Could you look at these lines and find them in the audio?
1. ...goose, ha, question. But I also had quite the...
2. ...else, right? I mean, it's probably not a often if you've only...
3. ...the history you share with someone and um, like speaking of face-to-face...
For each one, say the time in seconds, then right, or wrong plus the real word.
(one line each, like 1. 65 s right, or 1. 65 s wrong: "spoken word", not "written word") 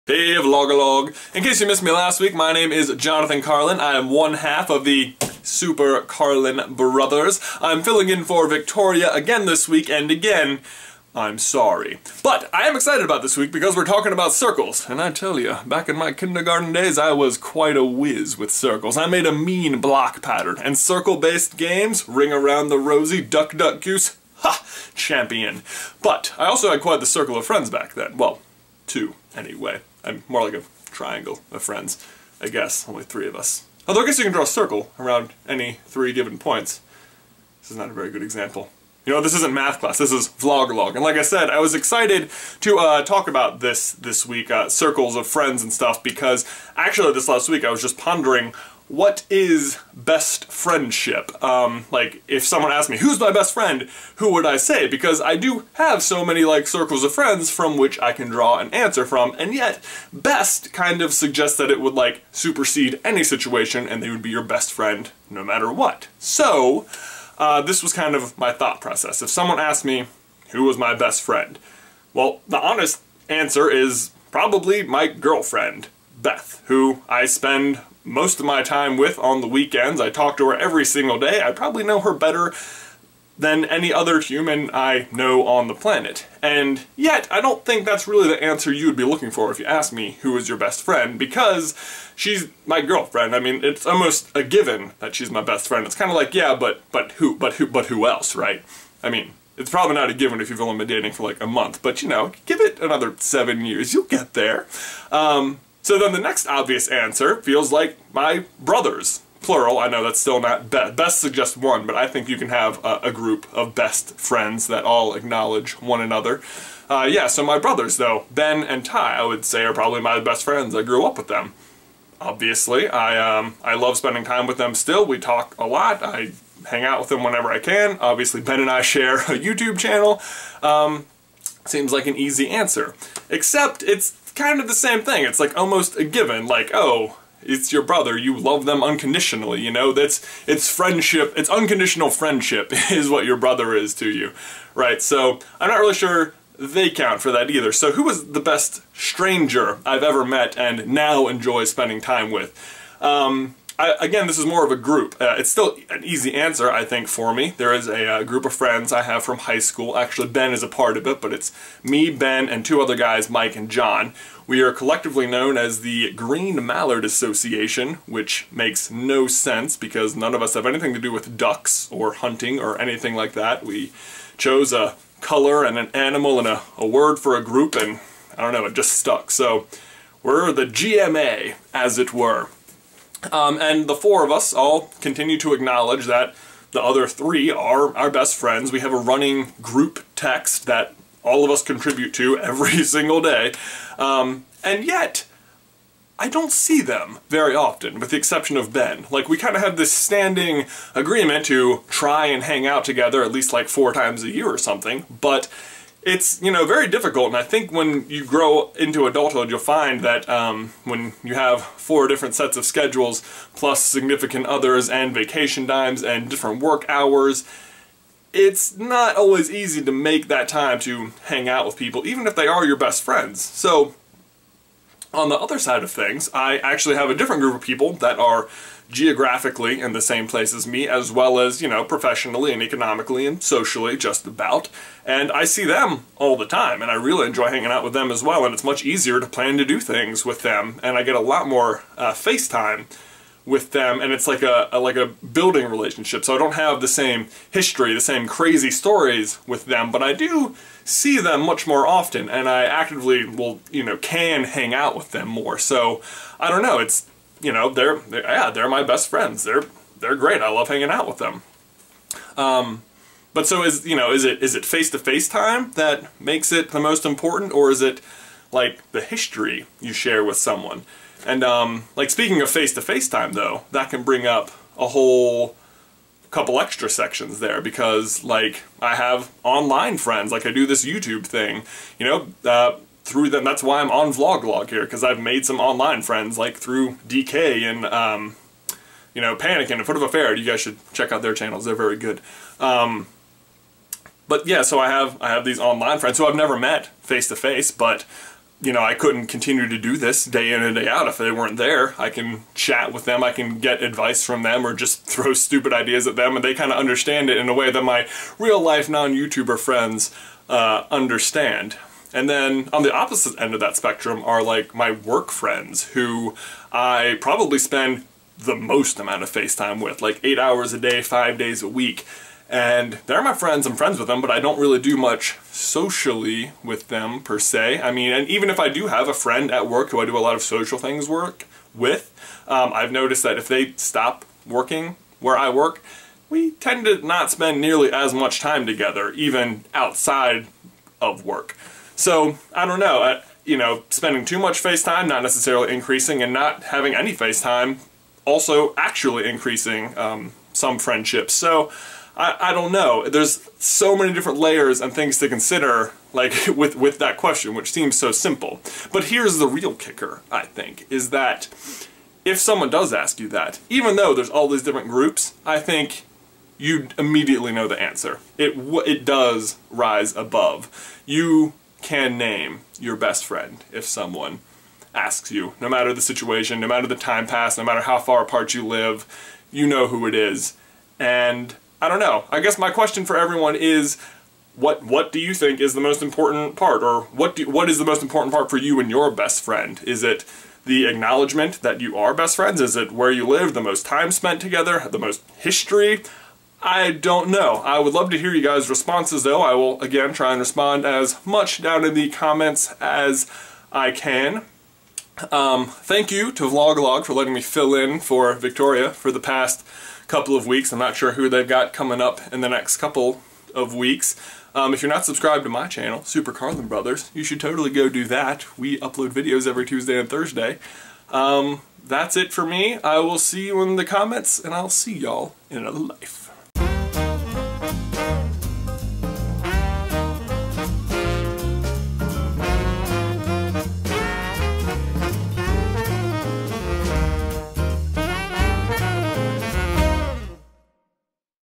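1. 23 s wrong: "champion", not "question"
2. 98 s wrong: "given", not "often"
3. 268 s right.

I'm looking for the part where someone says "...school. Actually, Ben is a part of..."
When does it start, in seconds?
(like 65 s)
159 s.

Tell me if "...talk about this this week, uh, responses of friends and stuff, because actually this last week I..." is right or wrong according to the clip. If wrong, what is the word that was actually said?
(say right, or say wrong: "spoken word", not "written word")
wrong: "circles", not "responses".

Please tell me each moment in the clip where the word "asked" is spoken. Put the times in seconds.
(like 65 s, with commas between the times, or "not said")
52 s, 69 s, 89 s.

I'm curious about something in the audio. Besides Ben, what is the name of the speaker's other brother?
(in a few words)
Ty.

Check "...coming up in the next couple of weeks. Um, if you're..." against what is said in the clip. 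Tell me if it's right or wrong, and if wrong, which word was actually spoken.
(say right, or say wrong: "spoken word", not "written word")
right.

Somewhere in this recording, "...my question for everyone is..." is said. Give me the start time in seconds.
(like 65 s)
382 s.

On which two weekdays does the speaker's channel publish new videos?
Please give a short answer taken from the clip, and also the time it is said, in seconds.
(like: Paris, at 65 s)
Tuesday and Thursday, at 419 s.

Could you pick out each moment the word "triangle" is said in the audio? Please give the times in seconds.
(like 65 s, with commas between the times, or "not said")
30 s.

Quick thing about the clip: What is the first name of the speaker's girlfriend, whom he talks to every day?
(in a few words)
Beth.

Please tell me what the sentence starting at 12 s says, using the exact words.
But I am excited about this week because we're talking about circles.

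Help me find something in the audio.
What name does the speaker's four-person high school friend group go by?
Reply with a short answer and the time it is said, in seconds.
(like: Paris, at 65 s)
Green Mallard Association, at 166 s.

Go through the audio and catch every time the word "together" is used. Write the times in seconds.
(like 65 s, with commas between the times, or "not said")
202 s, 338 s, 394 s.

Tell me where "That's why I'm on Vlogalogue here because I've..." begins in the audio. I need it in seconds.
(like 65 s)
283 s.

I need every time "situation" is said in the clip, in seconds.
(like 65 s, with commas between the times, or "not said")
63 s, 376 s.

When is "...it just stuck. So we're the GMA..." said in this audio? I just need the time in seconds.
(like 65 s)
178 s.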